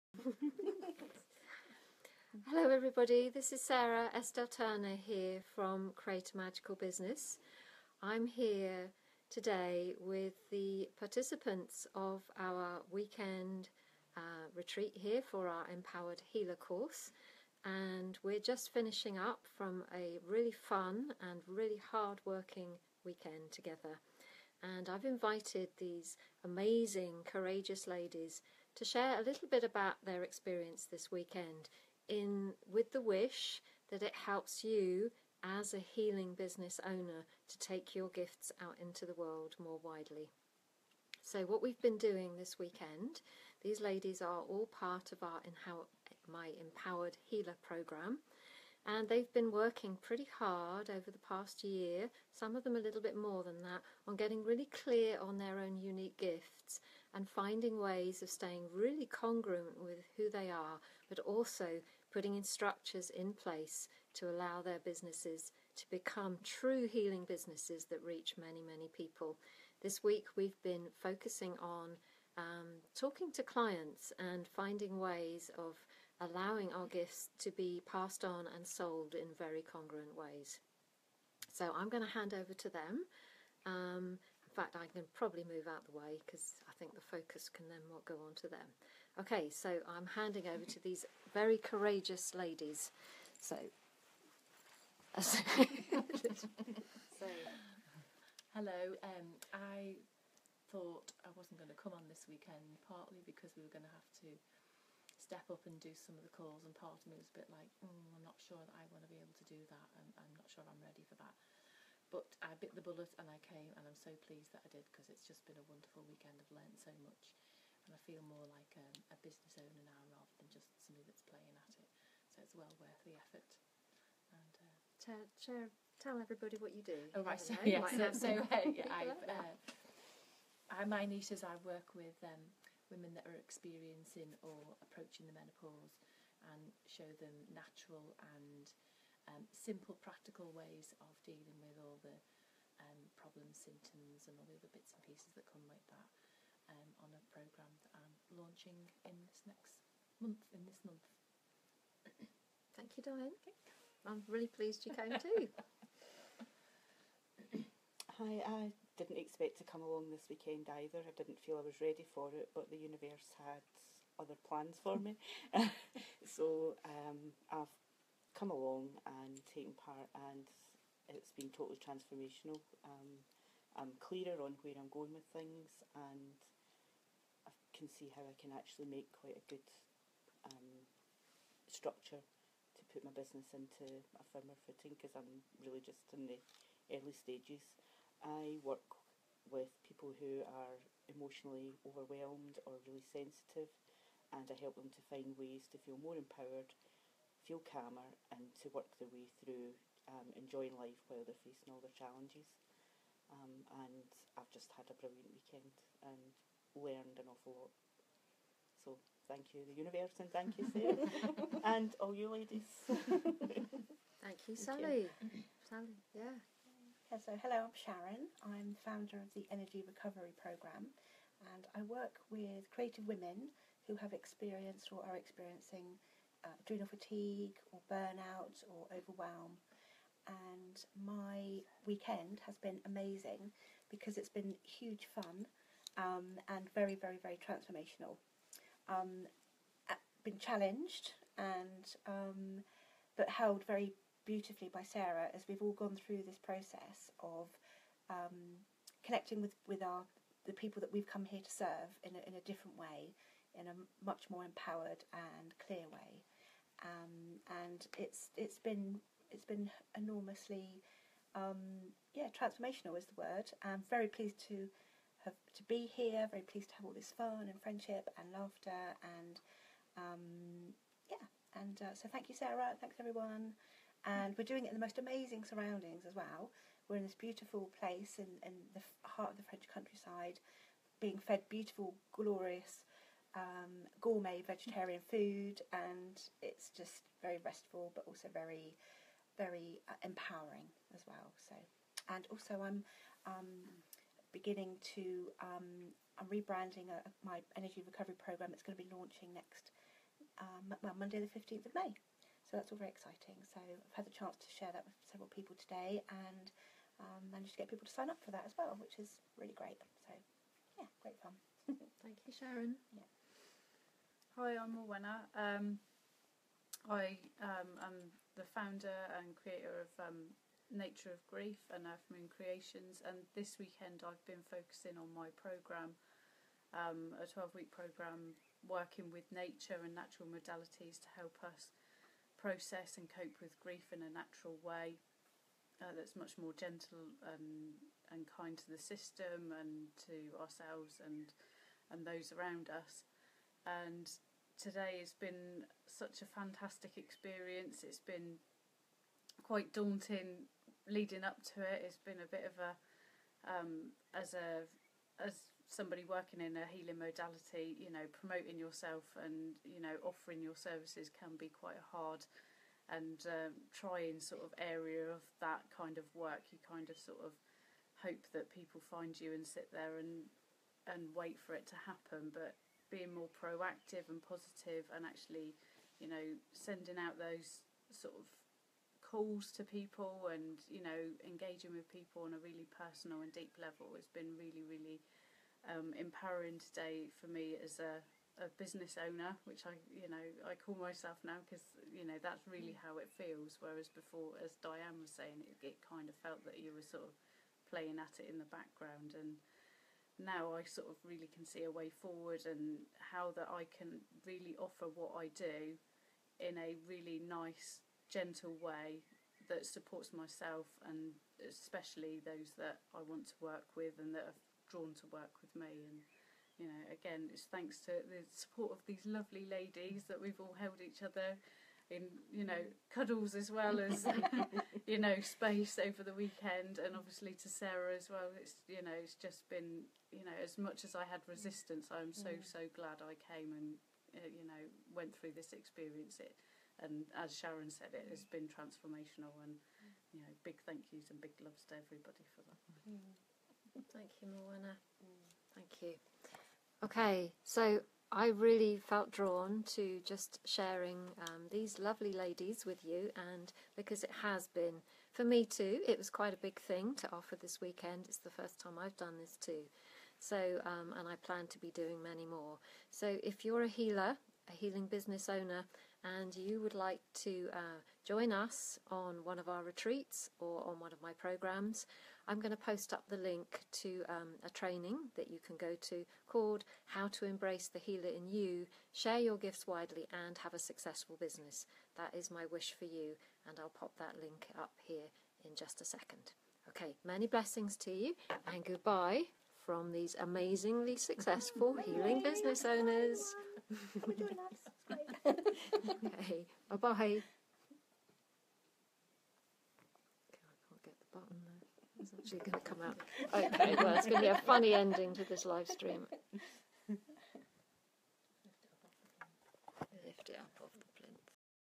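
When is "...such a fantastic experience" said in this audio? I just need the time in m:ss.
5:45.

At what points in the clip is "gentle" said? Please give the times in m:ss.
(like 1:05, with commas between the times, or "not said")
5:36, 6:48.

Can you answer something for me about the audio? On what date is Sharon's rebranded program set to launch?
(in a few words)
Monday 15th May.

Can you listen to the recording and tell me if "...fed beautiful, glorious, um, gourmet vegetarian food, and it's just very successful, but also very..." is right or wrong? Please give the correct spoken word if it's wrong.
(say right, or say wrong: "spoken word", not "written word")
wrong: "restful", not "successful".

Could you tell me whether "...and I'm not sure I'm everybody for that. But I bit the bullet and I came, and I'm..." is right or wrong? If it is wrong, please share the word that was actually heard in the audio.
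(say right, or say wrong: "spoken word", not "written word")
wrong: "ready", not "everybody".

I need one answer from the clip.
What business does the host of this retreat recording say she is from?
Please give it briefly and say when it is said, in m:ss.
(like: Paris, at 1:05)
Create a Magical Business, at 0:05.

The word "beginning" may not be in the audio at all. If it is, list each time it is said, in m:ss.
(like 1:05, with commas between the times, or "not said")
4:54.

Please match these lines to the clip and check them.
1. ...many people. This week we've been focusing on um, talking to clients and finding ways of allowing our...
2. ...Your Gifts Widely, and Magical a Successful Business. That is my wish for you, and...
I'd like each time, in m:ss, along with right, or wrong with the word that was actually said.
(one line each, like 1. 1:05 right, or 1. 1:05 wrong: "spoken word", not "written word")
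1. 1:08 right
2. 7:59 wrong: "Have", not "Magical".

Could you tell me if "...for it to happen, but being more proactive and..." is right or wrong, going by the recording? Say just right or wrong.
right.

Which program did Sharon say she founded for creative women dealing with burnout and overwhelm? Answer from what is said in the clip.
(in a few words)
Energy Recovery Programme.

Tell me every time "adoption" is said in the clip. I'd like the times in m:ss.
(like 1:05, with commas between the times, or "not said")
not said.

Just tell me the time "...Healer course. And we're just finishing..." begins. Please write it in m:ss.
0:16.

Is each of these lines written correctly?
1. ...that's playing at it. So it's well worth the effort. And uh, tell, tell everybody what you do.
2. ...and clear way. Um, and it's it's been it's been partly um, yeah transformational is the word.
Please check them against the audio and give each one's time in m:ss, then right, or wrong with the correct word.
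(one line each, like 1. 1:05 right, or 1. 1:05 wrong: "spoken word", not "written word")
1. 2:01 right
2. 4:15 wrong: "enormously", not "partly".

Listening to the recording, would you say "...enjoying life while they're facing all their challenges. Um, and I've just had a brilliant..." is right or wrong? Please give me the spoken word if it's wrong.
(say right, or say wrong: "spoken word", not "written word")
right.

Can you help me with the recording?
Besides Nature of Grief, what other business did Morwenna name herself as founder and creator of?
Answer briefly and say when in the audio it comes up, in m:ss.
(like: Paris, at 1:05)
Earth Moon Creations, at 5:21.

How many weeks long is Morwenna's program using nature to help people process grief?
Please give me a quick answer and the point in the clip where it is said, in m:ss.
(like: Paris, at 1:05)
12, at 5:27.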